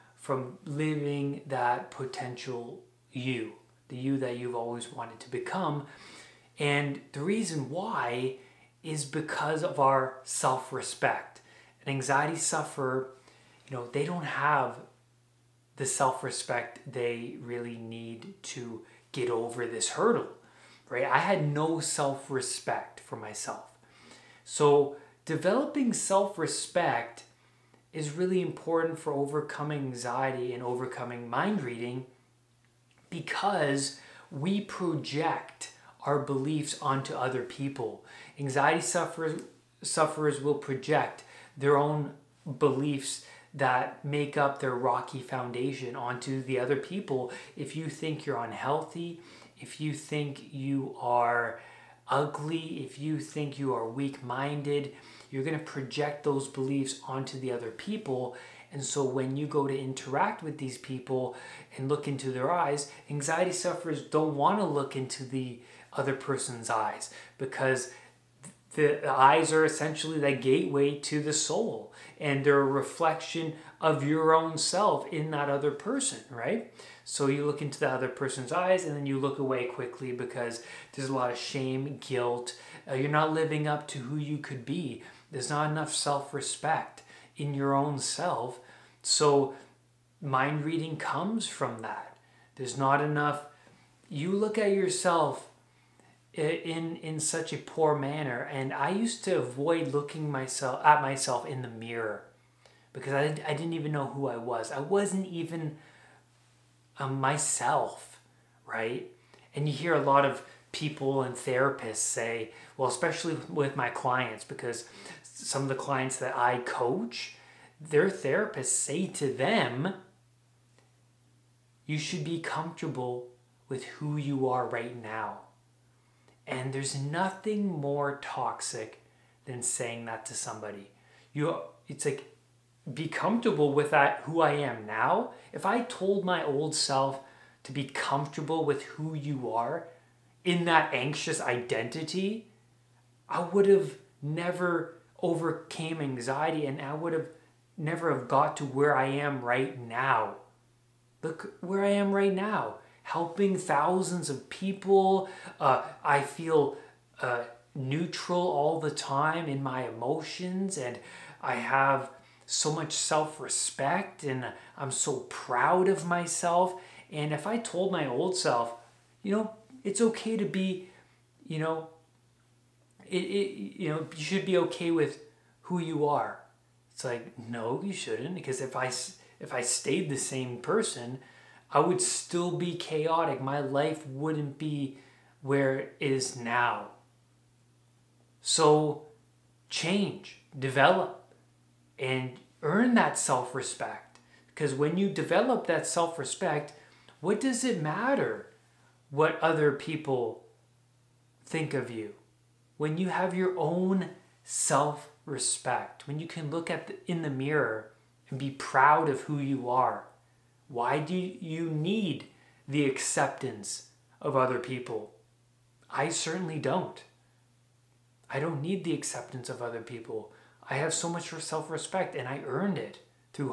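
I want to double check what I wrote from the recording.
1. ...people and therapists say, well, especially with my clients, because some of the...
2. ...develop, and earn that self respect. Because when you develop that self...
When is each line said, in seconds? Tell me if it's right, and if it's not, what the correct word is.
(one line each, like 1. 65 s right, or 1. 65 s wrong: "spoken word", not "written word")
1. 110 s right
2. 190 s right.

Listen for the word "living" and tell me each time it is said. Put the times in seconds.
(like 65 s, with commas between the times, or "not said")
0 s, 83 s.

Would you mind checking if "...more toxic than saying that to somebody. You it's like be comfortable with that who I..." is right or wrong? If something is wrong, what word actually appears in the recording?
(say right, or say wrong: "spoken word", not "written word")
right.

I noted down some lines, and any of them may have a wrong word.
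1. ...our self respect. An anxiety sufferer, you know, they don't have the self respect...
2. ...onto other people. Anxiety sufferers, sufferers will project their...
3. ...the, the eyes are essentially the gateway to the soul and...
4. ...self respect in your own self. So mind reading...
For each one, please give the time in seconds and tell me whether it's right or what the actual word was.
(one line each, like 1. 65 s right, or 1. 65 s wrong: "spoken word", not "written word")
1. 9 s right
2. 36 s right
3. 68 s right
4. 85 s right.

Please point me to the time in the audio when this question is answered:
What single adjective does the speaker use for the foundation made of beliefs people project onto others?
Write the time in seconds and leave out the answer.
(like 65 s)
44 s.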